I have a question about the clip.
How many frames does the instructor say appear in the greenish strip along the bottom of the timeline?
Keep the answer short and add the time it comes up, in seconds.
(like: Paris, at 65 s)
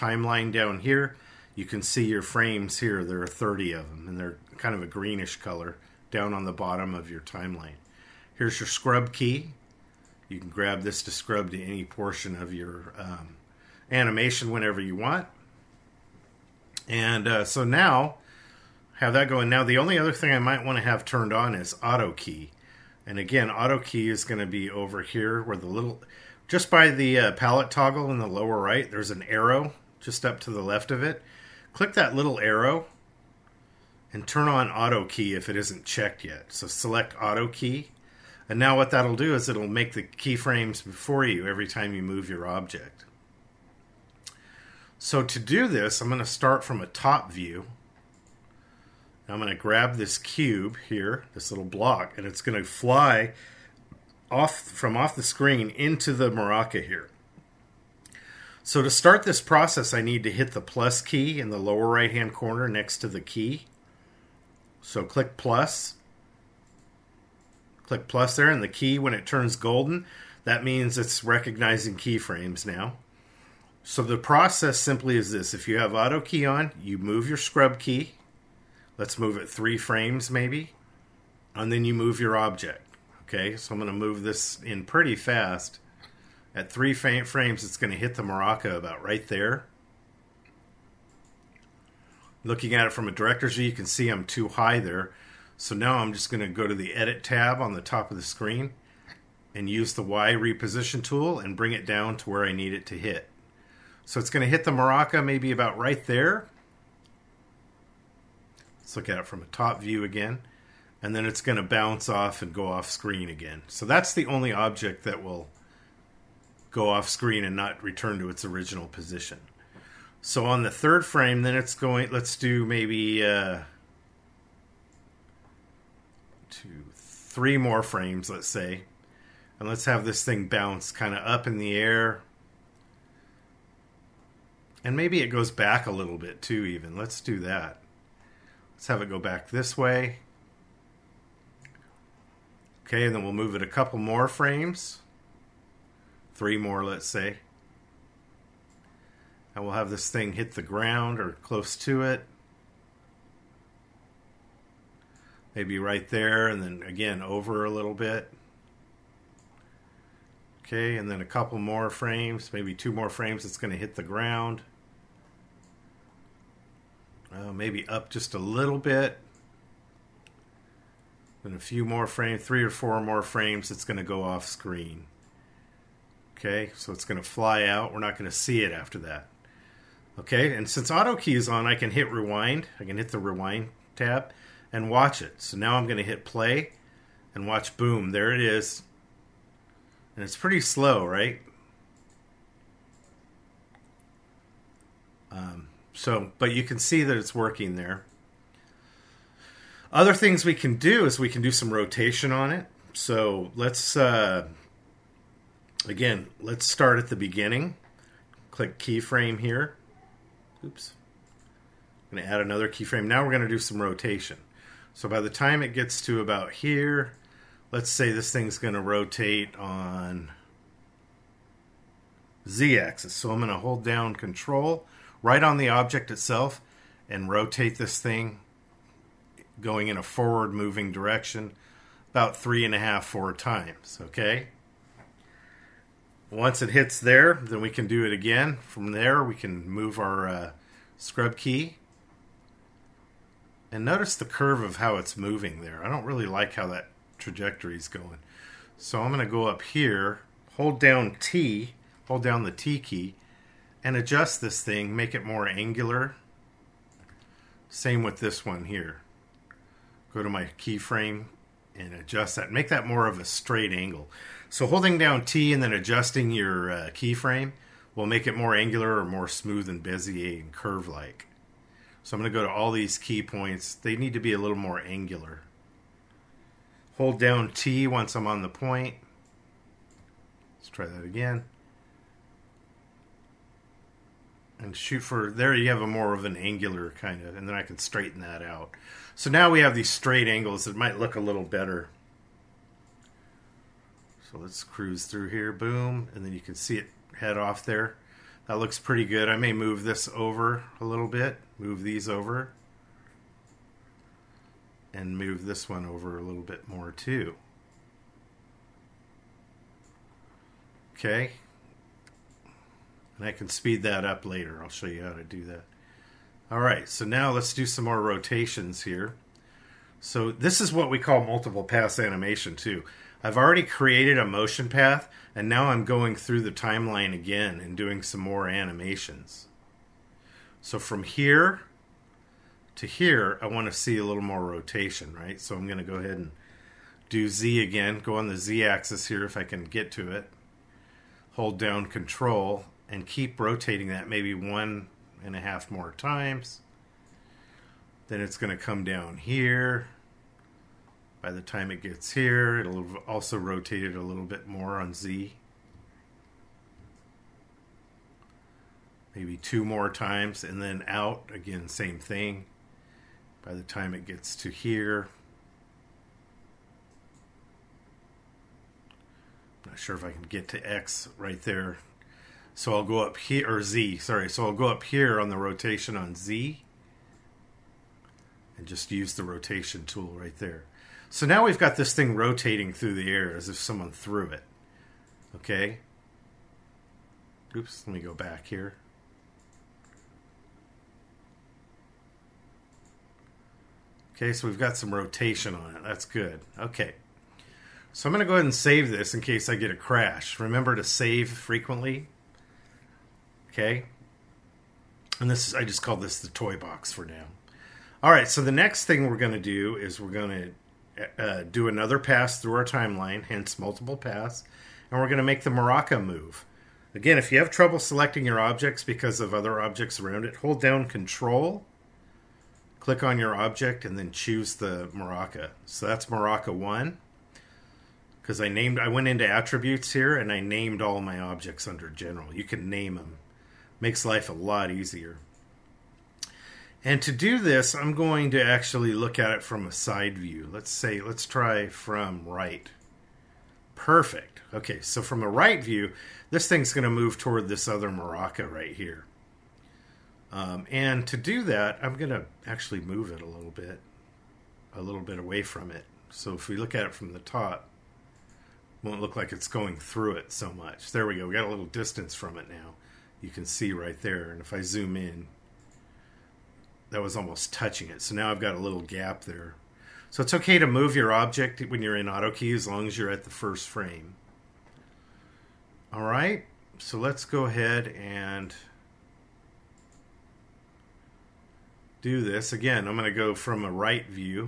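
30, at 3 s.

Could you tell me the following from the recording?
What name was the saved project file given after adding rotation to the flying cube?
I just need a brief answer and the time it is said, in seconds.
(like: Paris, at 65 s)
the toy box, at 406 s.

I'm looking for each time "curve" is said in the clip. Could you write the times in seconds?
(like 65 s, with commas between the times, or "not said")
244 s, 270 s.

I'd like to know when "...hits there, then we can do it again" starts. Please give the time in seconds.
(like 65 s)
236 s.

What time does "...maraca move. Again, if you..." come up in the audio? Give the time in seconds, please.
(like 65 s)
415 s.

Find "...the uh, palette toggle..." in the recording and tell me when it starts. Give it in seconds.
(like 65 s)
26 s.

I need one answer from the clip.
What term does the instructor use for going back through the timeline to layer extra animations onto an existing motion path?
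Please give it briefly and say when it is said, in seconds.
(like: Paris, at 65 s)
multiple pass animation, at 321 s.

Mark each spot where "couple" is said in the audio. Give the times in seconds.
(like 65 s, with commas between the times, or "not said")
143 s, 161 s.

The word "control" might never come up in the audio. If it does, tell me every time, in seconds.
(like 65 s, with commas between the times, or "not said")
224 s, 341 s, 420 s.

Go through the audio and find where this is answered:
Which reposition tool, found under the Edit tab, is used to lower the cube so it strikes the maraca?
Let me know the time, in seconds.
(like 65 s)
100 s.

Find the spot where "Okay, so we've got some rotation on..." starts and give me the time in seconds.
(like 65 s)
394 s.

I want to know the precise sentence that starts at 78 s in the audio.
Let's move it three frames maybe.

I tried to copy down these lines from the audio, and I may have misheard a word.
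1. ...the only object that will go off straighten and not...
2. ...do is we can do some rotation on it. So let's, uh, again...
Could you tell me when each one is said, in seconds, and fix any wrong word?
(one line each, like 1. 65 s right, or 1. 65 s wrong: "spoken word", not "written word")
1. 114 s wrong: "screen", not "straighten"
2. 200 s right.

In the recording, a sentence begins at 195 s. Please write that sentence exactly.
Um, so, but you can see that it's working there.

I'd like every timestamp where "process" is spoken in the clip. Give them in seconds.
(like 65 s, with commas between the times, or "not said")
59 s, 74 s.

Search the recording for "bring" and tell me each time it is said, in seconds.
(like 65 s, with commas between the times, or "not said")
101 s.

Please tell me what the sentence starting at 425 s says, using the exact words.
So that's maraca 1 because I named I went into attributes here and I named all my objects under general.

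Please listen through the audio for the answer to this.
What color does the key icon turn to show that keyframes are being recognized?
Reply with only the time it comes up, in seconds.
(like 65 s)
69 s.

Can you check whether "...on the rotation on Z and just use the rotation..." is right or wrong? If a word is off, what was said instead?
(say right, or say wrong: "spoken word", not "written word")
right.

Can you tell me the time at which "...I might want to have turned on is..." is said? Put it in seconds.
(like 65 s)
20 s.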